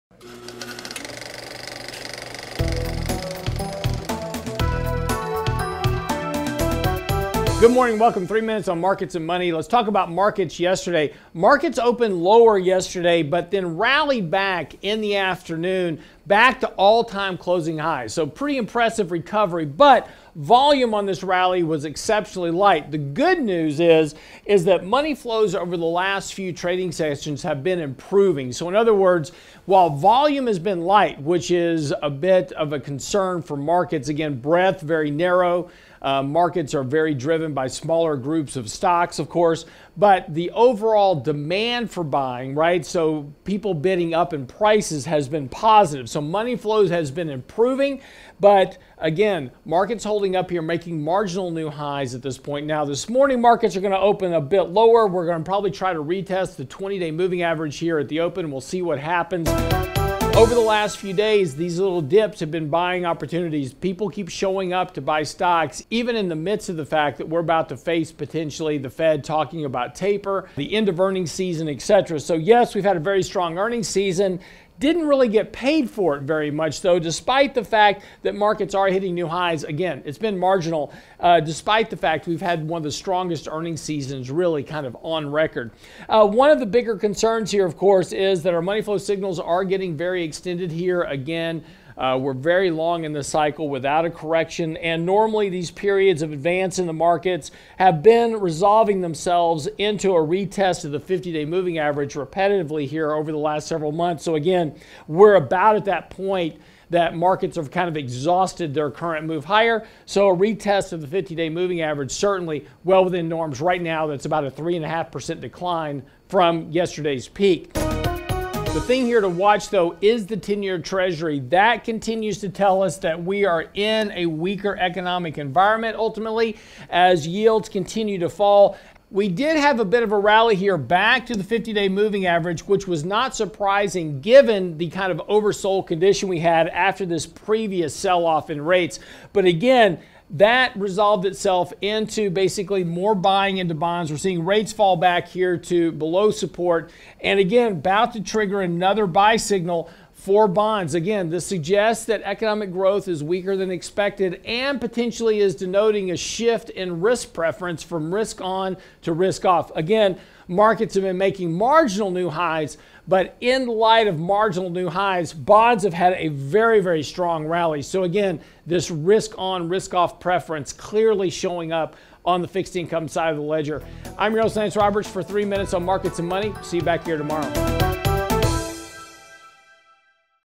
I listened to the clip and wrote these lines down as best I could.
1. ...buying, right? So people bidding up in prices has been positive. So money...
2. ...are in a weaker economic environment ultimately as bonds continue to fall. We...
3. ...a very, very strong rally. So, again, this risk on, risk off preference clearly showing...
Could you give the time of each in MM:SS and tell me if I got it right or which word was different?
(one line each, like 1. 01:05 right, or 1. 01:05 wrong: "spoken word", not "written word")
1. 00:42 right
2. 02:03 wrong: "yields", not "bonds"
3. 02:46 right.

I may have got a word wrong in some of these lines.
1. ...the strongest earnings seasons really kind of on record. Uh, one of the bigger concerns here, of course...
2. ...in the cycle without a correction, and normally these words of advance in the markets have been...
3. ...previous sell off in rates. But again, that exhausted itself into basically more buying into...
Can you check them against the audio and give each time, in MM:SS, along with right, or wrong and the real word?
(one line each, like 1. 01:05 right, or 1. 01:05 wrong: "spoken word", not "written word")
1. 01:22 right
2. 01:33 wrong: "periods", not "words"
3. 02:17 wrong: "resolved", not "exhausted".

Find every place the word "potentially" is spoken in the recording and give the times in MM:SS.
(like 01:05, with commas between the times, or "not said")
01:08, 02:34.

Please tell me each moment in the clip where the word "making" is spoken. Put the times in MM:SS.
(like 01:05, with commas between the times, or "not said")
00:50, 02:41.